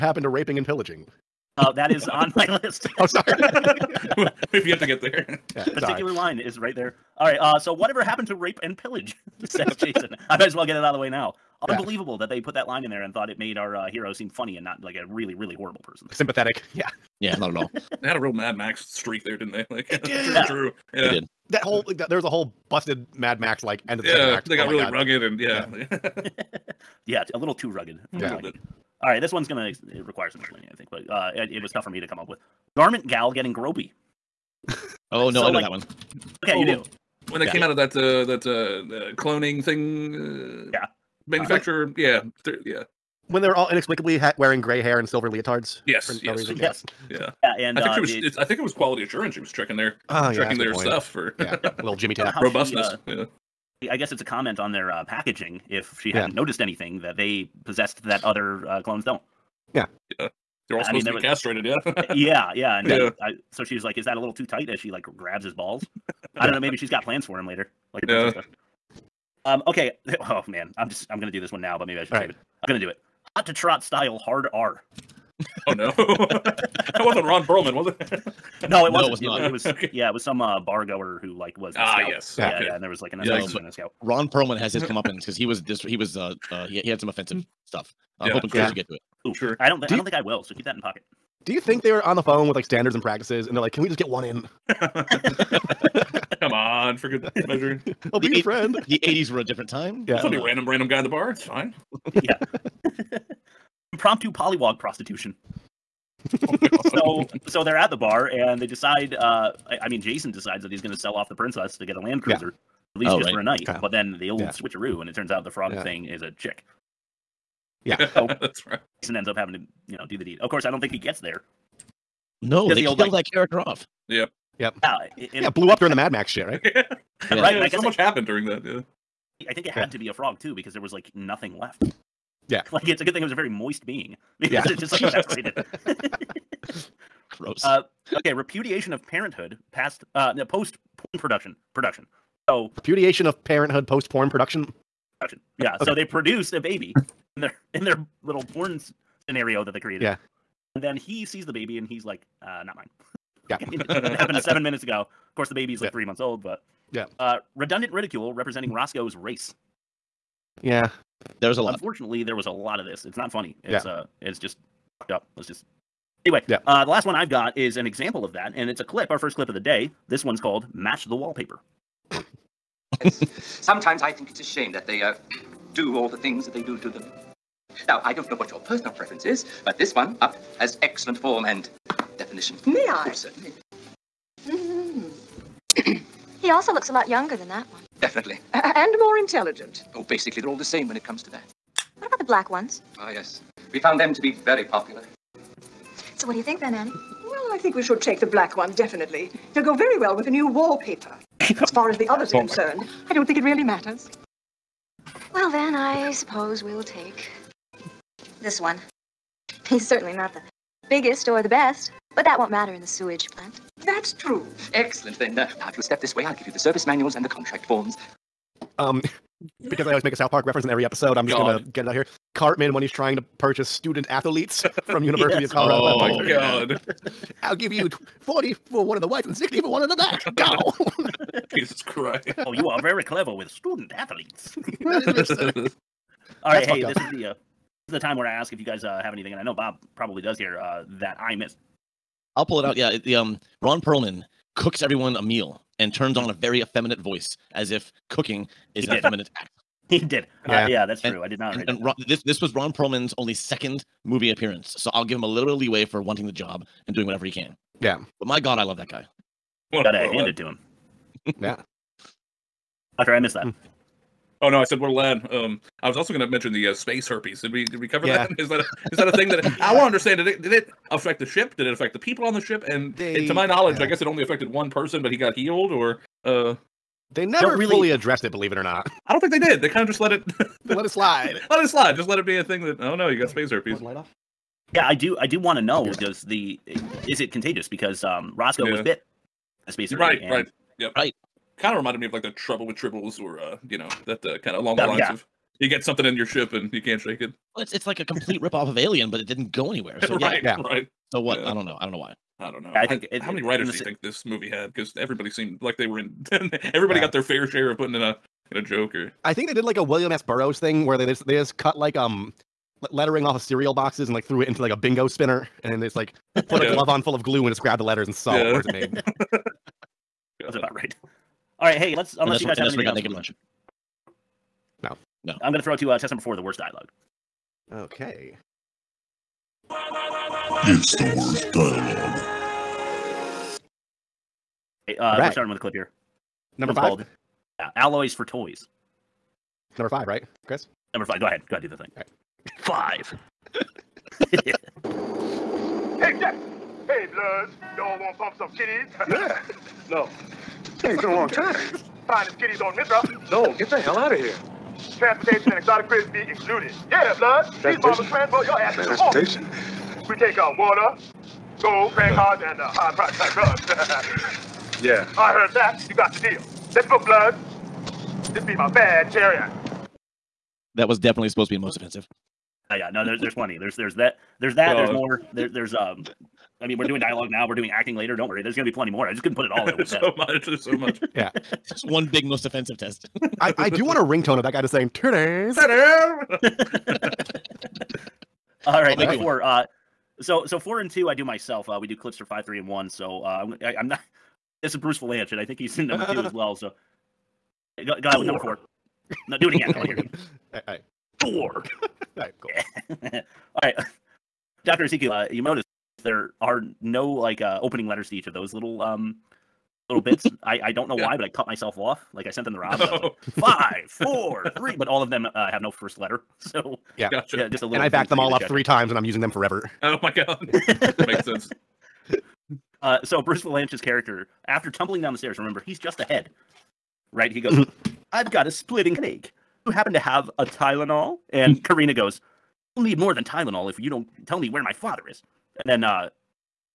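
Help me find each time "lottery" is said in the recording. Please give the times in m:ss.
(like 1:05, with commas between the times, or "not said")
not said.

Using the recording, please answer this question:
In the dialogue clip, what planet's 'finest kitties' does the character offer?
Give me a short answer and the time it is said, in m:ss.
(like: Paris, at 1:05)
Mithra, at 5:52.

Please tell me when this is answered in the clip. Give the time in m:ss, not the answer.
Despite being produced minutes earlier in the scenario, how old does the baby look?
2:35.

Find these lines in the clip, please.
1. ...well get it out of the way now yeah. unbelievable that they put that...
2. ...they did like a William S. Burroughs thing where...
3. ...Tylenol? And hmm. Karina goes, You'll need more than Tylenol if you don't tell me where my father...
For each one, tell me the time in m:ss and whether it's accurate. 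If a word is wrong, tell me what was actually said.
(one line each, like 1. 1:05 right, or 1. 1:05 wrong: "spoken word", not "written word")
1. 0:10 right
2. 5:09 right
3. 7:10 right.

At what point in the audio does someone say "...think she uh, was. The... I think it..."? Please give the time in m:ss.
0:47.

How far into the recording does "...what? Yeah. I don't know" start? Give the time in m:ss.
5:01.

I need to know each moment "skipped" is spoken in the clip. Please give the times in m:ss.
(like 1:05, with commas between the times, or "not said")
not said.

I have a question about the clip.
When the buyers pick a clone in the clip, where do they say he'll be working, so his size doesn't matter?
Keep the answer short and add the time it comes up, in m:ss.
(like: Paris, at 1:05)
sewage plant, at 3:32.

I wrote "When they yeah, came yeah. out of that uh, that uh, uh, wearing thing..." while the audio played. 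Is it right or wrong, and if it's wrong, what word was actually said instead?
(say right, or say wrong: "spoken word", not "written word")
wrong: "cloning", not "wearing".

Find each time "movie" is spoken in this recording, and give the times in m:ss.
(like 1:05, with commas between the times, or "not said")
4:14, 5:04.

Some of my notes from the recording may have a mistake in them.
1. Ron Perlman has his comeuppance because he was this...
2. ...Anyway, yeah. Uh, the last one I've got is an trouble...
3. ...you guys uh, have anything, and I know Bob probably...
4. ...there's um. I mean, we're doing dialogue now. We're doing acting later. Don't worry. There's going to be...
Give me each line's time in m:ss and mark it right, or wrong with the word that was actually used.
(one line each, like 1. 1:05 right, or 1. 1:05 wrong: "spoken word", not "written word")
1. 1:24 right
2. 2:46 wrong: "example", not "trouble"
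3. 3:58 right
4. 6:15 right.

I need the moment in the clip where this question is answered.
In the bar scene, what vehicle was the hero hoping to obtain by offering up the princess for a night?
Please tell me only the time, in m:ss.
1:51.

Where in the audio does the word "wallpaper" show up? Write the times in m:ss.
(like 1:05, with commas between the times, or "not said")
2:51, 3:20.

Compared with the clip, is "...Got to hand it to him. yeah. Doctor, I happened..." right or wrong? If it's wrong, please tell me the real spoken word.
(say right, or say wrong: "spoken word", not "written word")
wrong: "missed", not "happened".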